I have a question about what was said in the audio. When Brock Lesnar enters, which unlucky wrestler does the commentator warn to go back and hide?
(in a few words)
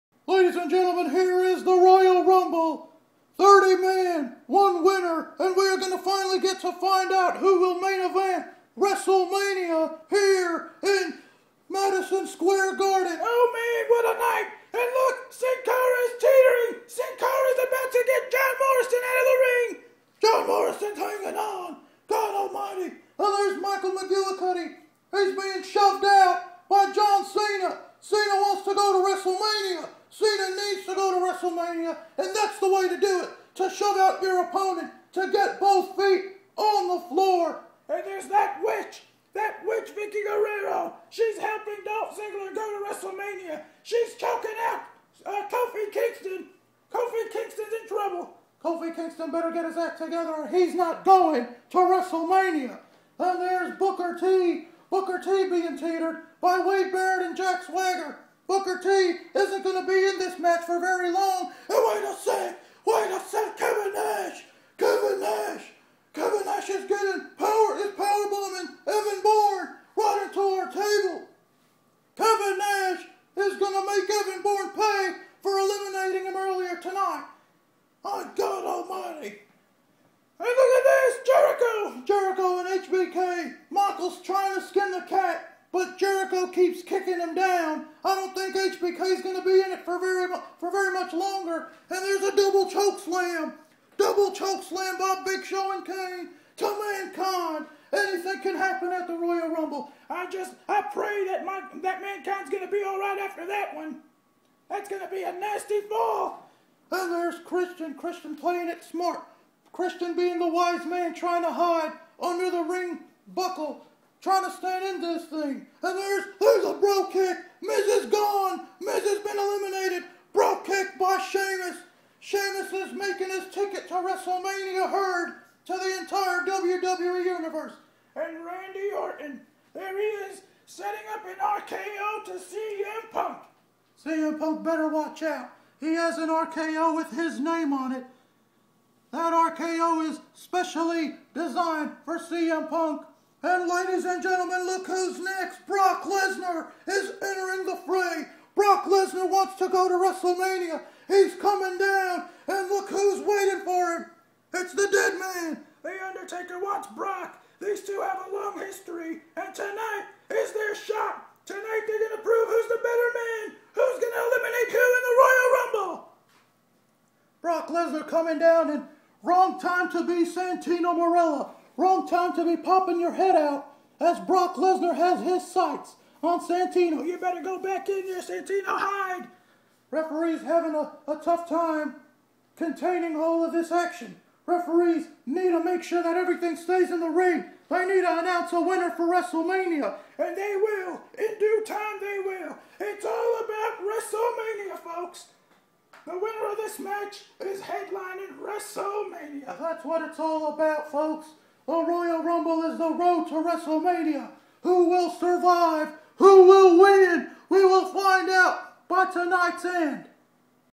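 Santino Marella.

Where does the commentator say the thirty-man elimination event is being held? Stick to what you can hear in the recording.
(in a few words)
Madison Square Garden.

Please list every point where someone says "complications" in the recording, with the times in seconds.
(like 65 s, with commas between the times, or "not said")
not said.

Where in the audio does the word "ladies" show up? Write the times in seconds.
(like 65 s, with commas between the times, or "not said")
0 s, 143 s.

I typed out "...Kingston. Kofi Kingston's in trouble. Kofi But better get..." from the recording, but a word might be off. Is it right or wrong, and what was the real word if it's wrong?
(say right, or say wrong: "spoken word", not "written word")
wrong: "Kingston", not "But".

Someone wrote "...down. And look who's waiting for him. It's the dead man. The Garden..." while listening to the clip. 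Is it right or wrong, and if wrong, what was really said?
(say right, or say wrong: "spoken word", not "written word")
wrong: "Undertaker", not "Garden".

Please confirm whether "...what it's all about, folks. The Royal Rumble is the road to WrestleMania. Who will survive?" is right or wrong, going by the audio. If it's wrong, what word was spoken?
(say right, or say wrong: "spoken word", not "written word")
right.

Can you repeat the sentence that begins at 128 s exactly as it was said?
And Randy Orton, there he is, setting up an RKO to CM Punk.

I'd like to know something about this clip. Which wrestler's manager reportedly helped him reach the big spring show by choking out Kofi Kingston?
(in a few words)
Dolph Ziggler.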